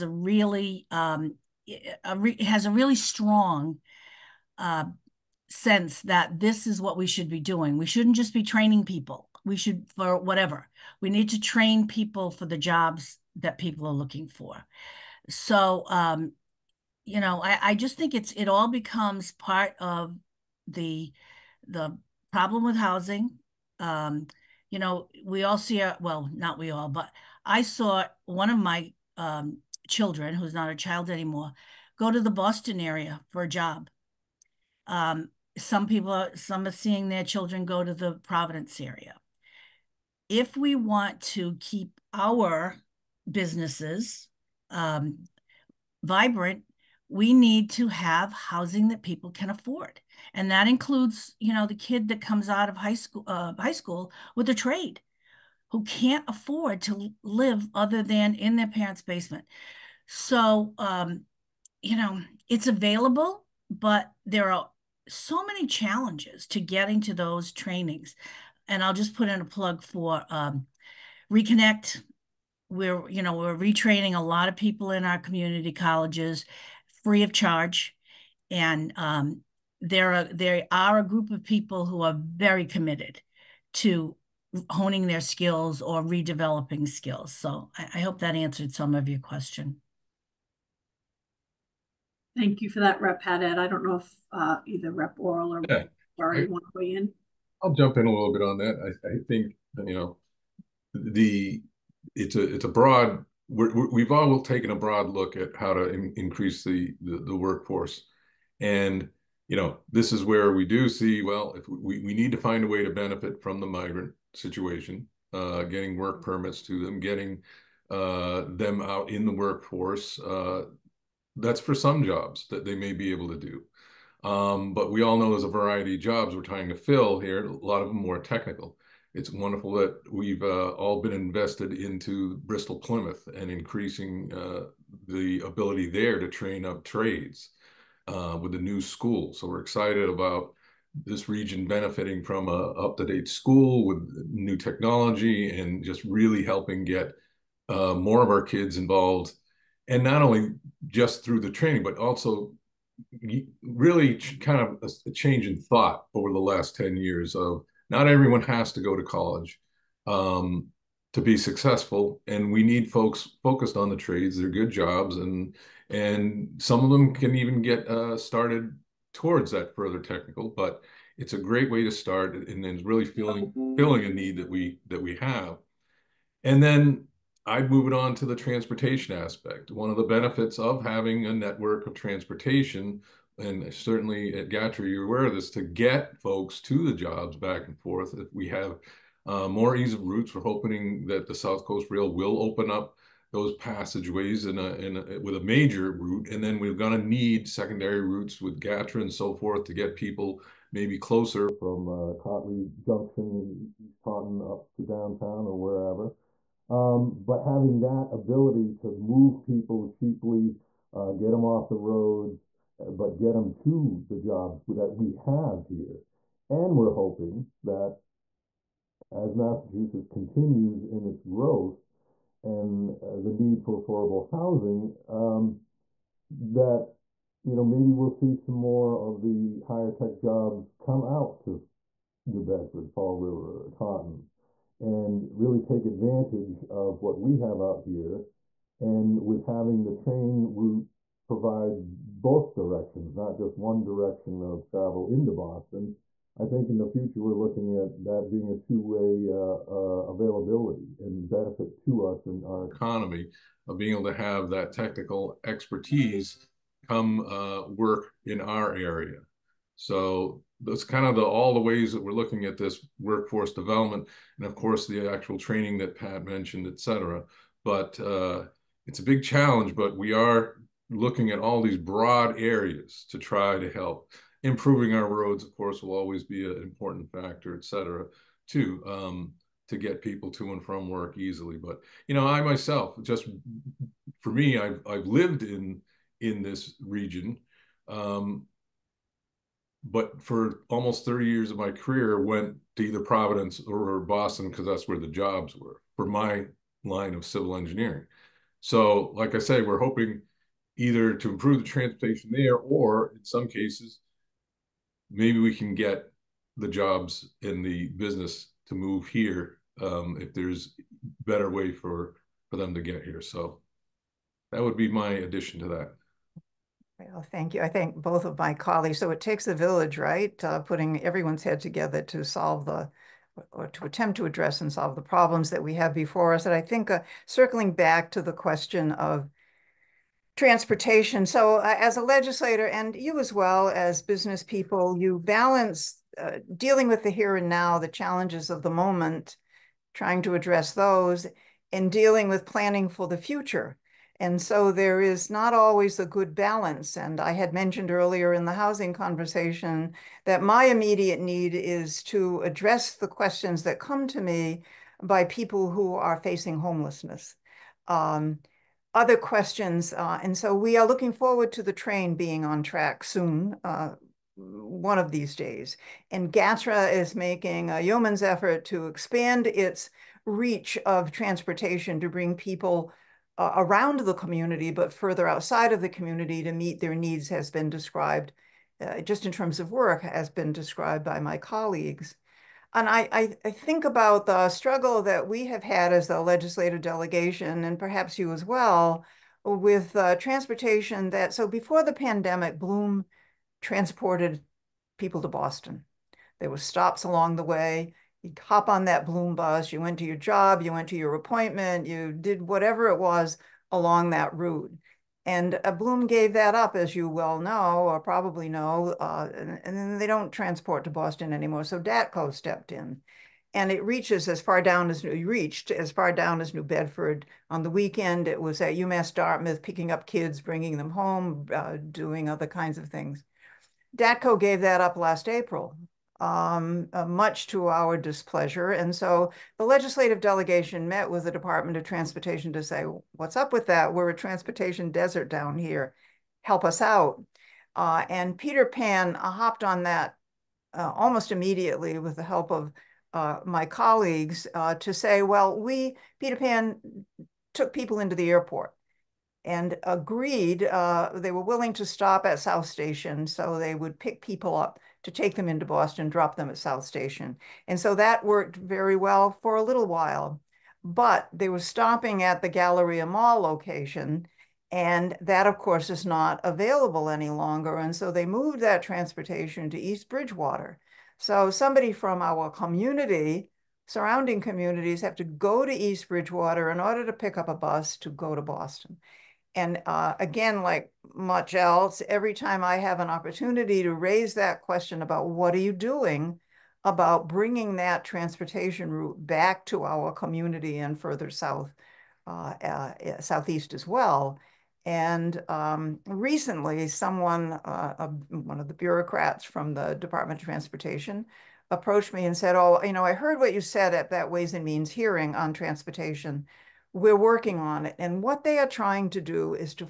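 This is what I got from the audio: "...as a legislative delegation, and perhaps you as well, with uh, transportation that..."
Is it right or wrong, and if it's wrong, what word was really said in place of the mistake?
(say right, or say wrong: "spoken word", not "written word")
right.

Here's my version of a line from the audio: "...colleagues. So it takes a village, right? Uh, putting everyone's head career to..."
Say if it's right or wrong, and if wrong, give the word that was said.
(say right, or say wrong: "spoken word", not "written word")
wrong: "together", not "career".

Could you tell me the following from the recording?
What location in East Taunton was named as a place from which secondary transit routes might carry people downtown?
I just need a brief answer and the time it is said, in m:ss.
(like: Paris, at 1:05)
Cotley Junction, at 3:22.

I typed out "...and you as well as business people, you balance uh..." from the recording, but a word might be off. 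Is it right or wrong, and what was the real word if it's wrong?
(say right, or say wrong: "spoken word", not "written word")
right.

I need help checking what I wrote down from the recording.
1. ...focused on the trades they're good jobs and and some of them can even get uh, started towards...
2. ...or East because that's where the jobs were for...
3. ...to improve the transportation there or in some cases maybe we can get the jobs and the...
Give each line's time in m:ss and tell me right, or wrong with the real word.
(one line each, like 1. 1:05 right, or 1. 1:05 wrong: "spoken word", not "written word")
1. 2:43 right
2. 4:53 wrong: "Boston", not "East"
3. 5:01 right.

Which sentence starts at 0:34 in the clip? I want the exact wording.
Um, some people, are, some are seeing their children go to the Providence area.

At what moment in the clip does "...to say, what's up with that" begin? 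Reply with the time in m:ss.
7:12.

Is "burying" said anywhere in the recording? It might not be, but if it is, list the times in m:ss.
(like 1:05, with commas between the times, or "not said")
not said.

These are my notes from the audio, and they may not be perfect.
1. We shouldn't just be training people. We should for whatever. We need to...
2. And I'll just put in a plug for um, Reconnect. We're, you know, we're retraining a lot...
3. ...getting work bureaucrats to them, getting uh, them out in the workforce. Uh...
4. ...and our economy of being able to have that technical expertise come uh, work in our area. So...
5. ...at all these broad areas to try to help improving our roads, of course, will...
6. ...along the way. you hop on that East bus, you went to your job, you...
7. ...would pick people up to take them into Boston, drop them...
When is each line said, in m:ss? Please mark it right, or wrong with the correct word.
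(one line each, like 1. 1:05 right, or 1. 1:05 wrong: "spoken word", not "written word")
1. 0:07 right
2. 1:08 right
3. 1:55 wrong: "permits", not "bureaucrats"
4. 4:12 right
5. 4:31 right
6. 6:37 wrong: "Bloom", not "East"
7. 7:33 right.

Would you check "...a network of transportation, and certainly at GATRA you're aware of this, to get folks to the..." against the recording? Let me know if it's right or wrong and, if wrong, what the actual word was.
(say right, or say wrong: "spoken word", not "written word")
right.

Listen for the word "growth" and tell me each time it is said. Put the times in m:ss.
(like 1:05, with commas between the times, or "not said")
3:41.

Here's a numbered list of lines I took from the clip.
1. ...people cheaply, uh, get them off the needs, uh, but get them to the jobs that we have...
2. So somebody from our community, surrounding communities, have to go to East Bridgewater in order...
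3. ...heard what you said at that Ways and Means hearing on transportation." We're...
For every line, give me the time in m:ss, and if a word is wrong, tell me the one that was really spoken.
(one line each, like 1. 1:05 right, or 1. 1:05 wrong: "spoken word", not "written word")
1. 3:29 wrong: "roads", not "needs"
2. 7:51 right
3. 8:23 right.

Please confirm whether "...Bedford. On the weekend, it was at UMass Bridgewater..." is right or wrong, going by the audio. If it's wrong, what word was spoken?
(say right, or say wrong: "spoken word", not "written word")
wrong: "Dartmouth", not "Bridgewater".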